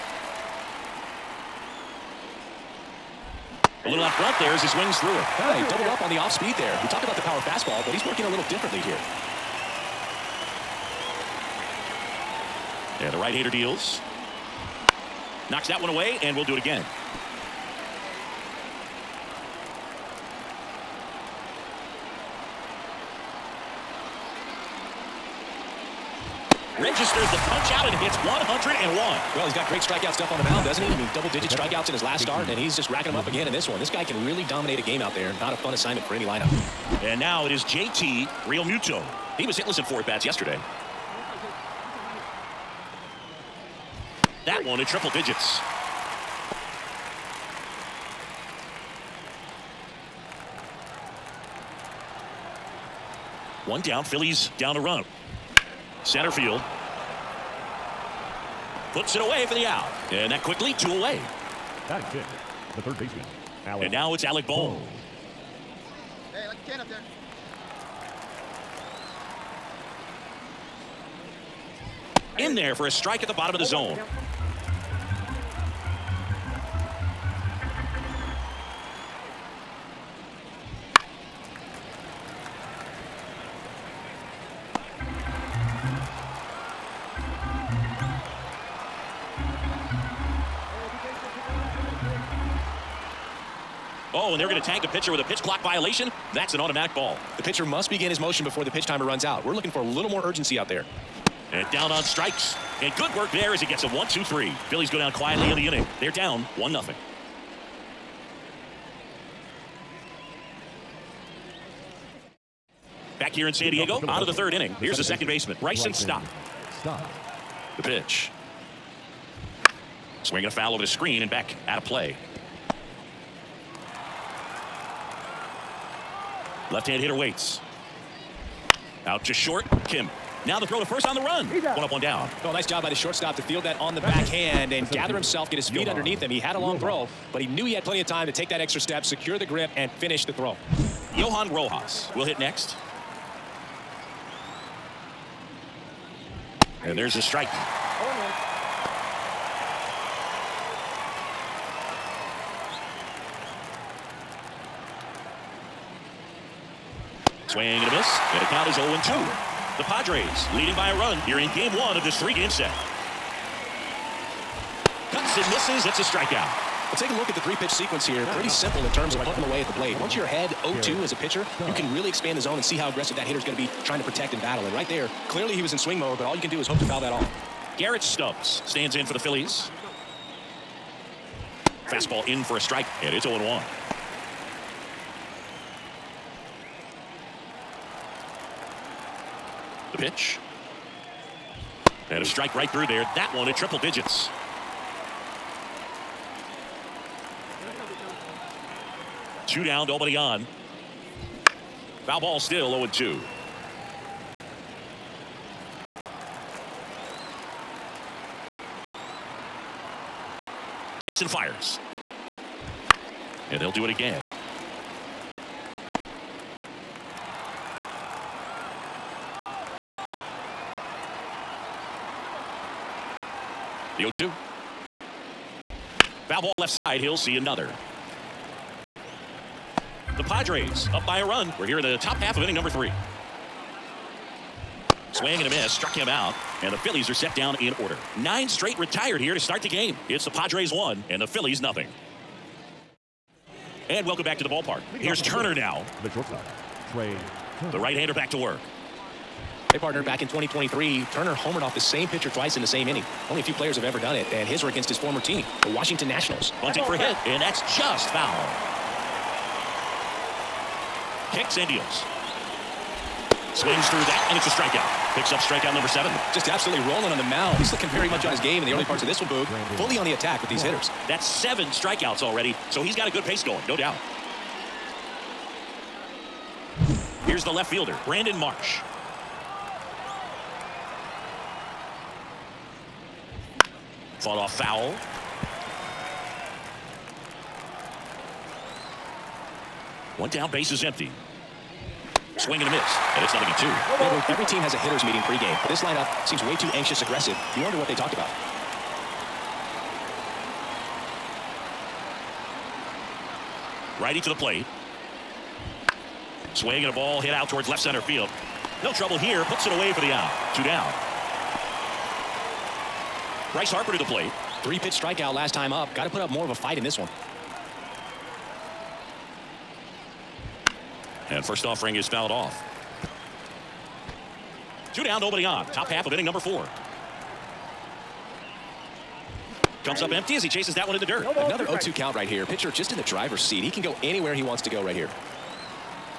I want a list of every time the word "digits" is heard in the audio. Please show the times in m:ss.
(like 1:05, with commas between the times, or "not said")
0:31, 0:45, 3:13.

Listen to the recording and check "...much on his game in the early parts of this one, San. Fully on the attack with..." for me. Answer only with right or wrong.
wrong.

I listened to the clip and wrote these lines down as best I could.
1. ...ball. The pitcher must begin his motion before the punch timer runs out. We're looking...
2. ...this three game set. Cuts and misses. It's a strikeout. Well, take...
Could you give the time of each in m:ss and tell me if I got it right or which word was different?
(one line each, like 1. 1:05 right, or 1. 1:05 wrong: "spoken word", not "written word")
1. 1:36 wrong: "pitch", not "punch"
2. 2:42 right.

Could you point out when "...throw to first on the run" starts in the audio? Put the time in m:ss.
2:10.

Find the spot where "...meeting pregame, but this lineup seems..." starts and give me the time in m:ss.
4:55.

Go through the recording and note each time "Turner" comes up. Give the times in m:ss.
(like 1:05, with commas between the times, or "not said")
4:05, 4:11.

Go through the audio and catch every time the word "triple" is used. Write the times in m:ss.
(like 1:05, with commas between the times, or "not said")
0:44, 3:13.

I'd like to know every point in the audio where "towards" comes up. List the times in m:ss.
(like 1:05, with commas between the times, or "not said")
5:07.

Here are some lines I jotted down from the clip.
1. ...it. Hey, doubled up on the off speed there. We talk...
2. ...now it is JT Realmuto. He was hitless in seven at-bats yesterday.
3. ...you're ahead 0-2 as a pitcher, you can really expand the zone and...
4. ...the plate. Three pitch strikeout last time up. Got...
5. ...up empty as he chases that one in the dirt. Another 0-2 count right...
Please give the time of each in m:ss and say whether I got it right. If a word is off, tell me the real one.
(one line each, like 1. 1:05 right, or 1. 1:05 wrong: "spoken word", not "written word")
1. 0:05 right
2. 0:37 wrong: "four", not "seven"
3. 2:50 right
4. 5:13 right
5. 5:29 right.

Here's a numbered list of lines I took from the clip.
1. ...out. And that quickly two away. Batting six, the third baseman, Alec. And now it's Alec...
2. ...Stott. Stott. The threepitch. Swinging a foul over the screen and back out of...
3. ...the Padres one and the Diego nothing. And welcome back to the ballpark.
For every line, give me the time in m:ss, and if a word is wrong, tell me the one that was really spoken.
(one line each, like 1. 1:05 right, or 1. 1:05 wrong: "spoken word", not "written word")
1. 0:59 right
2. 1:55 wrong: "pitch", not "threepitch"
3. 4:00 wrong: "Phillies", not "Diego".